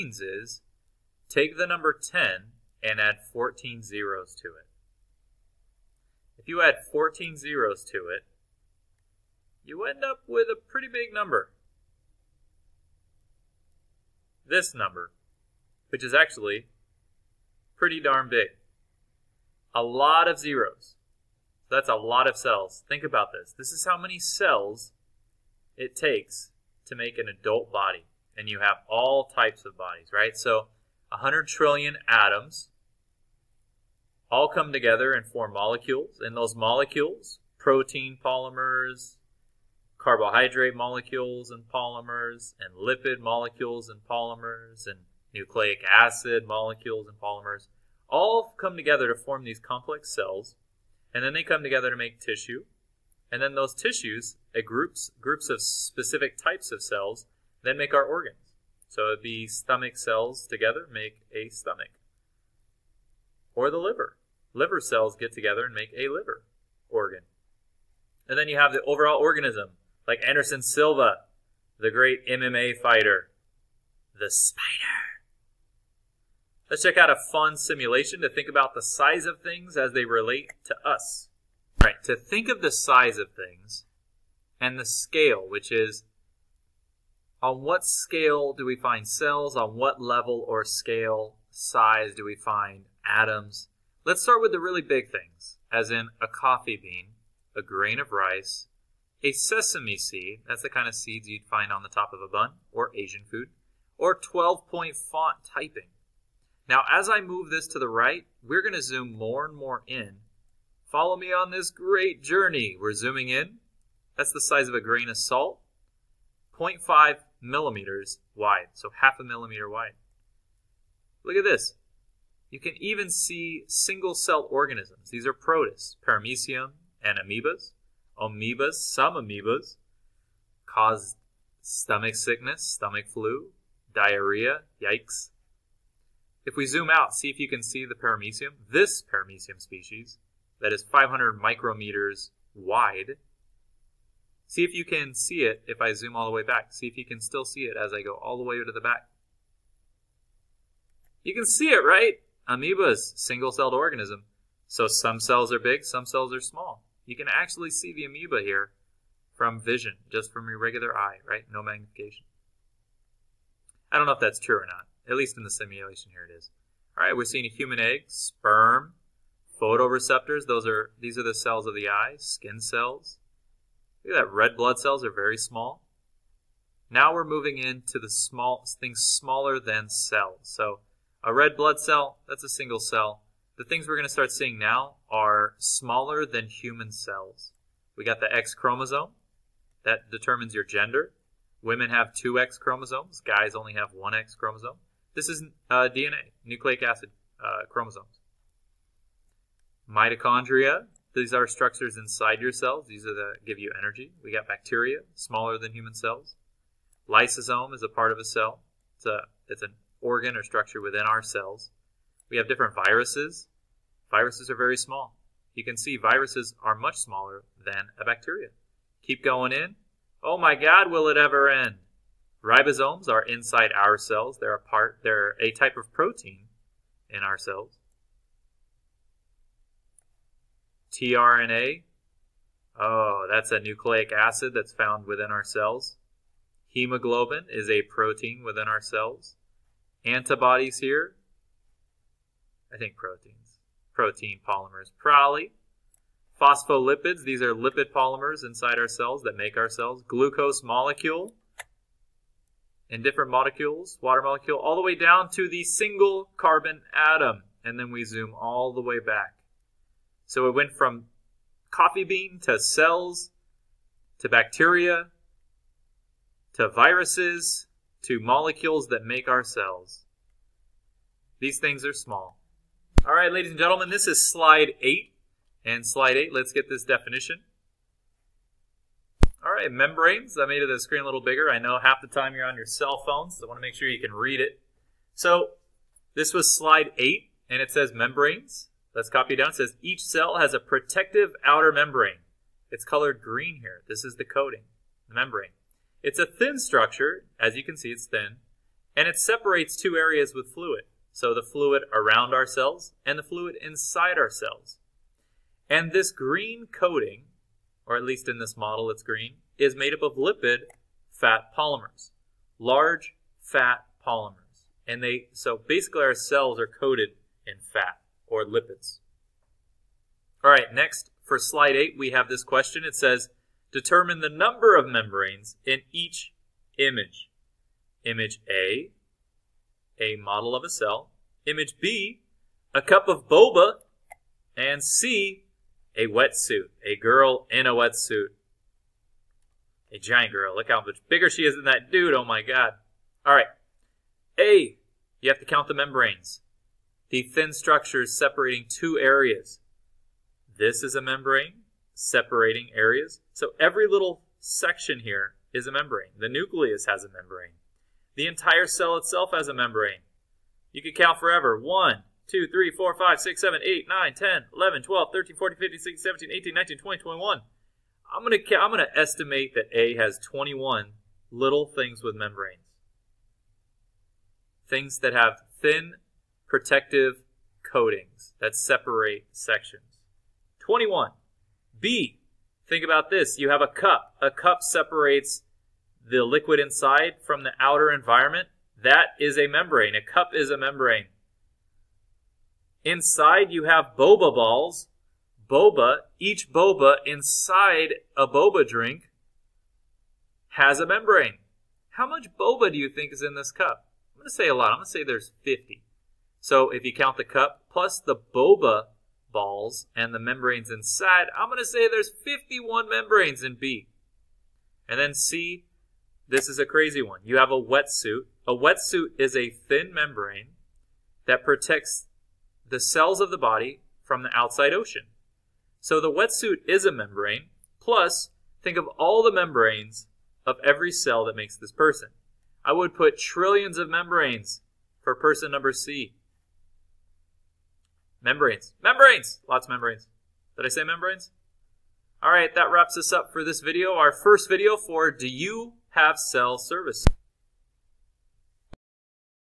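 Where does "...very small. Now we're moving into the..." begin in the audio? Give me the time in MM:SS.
02:55.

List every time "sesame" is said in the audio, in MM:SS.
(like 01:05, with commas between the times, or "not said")
01:39.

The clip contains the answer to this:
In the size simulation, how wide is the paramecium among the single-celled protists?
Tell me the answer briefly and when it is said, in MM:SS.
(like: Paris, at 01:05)
500 micrometers, at 02:20.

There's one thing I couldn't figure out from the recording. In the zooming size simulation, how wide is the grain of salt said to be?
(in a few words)
0.5 millimeters.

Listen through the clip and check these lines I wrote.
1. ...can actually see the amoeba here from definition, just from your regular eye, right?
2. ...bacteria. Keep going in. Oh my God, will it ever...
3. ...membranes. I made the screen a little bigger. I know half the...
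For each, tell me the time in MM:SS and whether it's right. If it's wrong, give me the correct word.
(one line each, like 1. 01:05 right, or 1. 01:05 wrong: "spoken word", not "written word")
1. 02:37 wrong: "vision", not "definition"
2. 03:38 right
3. 04:39 right.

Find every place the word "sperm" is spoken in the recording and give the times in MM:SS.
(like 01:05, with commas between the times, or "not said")
02:48.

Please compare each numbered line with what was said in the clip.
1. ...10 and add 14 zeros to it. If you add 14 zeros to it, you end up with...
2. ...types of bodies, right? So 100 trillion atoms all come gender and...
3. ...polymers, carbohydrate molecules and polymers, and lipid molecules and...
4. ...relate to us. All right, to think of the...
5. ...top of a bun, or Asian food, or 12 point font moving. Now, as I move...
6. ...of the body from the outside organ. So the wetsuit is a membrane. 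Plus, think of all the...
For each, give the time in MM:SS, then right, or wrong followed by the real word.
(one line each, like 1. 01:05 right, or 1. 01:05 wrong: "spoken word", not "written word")
1. 00:01 right
2. 00:29 wrong: "together", not "gender"
3. 00:38 right
4. 01:20 right
5. 01:41 wrong: "typing", not "moving"
6. 07:03 wrong: "ocean", not "organ".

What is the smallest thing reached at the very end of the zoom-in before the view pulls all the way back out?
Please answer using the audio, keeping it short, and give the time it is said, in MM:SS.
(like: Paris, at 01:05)
single carbon atom, at 04:15.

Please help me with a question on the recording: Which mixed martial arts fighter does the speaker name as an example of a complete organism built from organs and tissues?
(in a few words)
Anderson Silva.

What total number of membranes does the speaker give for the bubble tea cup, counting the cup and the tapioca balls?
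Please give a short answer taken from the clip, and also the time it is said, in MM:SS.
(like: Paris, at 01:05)
51, at 06:52.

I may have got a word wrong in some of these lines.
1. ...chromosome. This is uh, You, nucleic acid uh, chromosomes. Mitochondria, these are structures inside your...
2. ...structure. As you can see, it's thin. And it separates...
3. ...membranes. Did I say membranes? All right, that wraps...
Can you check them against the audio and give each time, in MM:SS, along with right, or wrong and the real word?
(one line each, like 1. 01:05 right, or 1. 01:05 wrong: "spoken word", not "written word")
1. 03:14 wrong: "DNA", not "You"
2. 04:56 right
3. 07:19 right.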